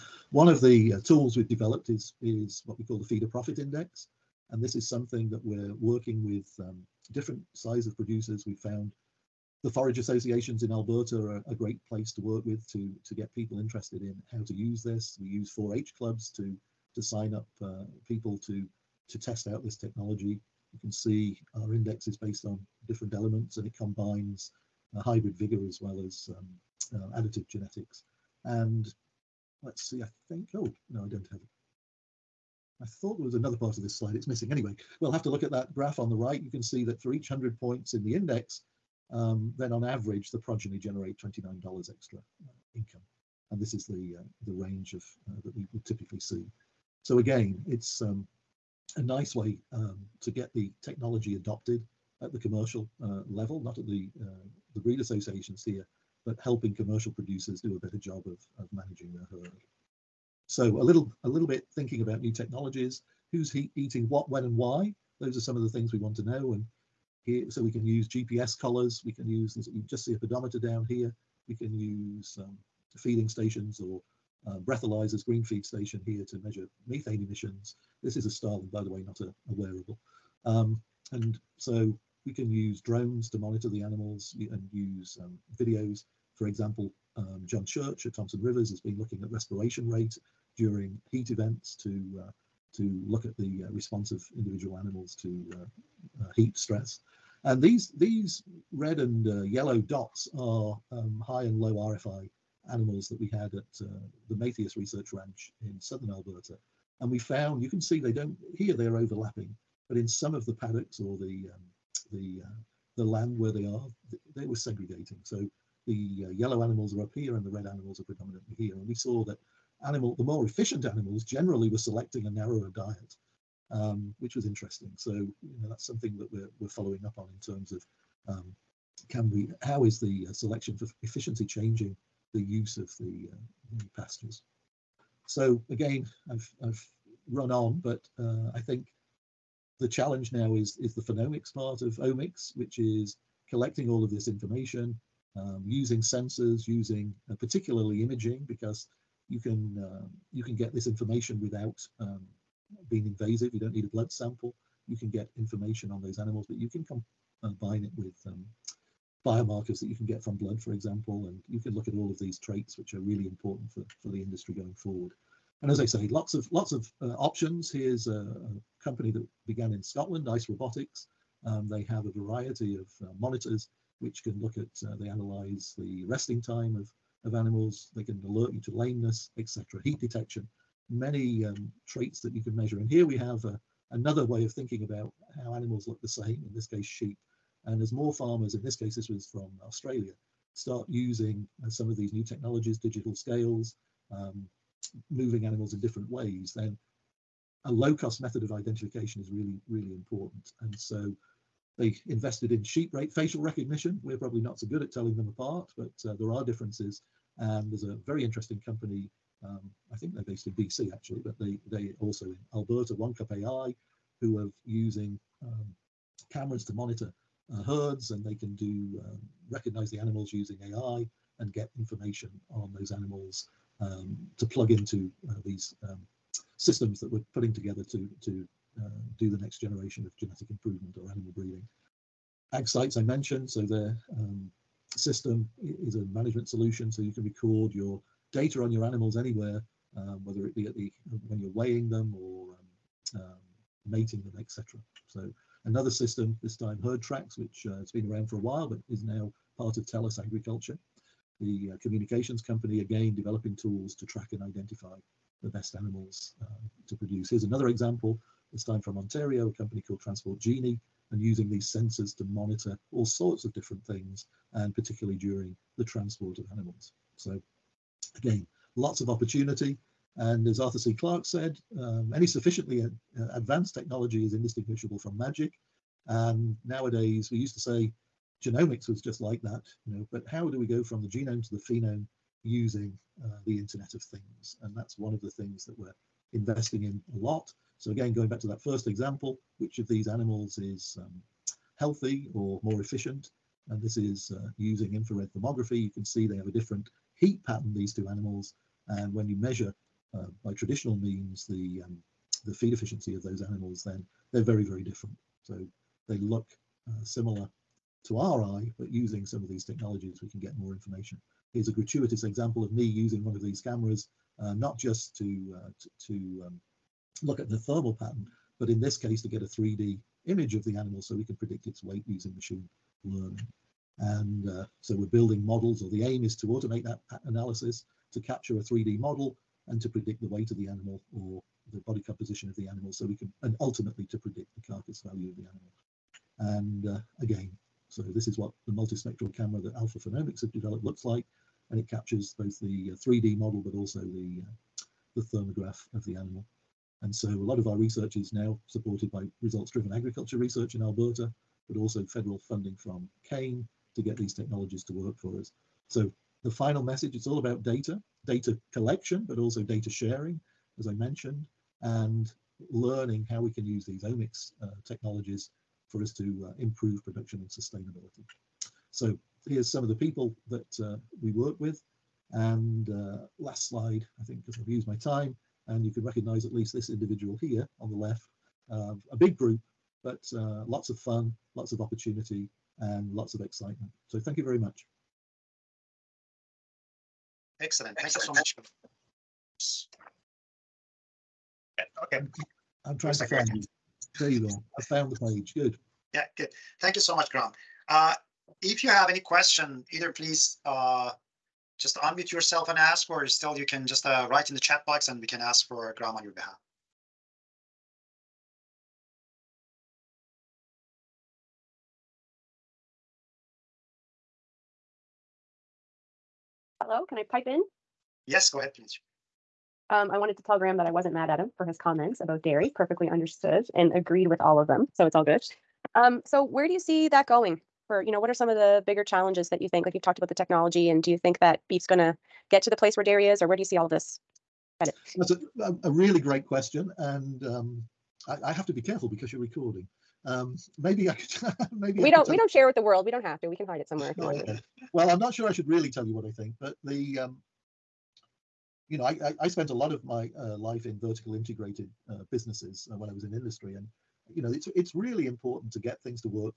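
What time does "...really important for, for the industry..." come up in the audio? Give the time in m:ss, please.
2:42.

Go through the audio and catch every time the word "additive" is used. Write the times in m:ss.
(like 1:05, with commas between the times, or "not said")
0:27.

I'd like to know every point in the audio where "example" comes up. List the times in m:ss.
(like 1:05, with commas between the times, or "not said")
1:26, 2:40, 4:17, 4:48, 5:12.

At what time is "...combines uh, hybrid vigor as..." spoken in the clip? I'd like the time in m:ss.
0:23.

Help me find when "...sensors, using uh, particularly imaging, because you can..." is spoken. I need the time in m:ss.
2:26.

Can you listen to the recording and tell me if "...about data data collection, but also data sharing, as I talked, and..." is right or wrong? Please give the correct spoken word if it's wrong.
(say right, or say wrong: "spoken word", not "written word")
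wrong: "mentioned", not "talked".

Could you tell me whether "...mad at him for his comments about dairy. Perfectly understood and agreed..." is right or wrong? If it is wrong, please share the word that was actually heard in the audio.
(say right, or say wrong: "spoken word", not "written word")
right.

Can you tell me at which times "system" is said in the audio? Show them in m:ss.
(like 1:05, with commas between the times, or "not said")
3:46, 3:54, 4:05.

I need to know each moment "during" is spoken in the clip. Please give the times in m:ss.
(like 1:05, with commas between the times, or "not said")
1:30, 4:25.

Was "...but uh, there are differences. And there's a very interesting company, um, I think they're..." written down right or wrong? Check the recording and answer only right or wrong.
right.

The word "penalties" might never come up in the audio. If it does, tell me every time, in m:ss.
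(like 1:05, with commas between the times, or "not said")
not said.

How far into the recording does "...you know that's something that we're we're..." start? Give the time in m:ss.
2:05.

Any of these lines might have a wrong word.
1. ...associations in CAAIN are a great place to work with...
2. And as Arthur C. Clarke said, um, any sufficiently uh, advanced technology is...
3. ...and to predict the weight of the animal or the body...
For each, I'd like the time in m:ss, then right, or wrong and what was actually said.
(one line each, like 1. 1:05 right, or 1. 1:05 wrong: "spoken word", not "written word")
1. 0:09 wrong: "Alberta", not "CAAIN"
2. 4:30 right
3. 5:29 right.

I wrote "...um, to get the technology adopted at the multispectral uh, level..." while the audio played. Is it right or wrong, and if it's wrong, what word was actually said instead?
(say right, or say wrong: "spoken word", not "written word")
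wrong: "commercial", not "multispectral".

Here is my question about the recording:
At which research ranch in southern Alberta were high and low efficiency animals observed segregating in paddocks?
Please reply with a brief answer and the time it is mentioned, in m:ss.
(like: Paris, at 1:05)
Mattheis Research Ranch, at 1:44.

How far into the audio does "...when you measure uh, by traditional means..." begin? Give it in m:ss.
4:59.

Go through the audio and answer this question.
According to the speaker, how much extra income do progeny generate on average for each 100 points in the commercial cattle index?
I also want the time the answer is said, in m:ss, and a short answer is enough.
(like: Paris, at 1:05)
$29, at 0:41.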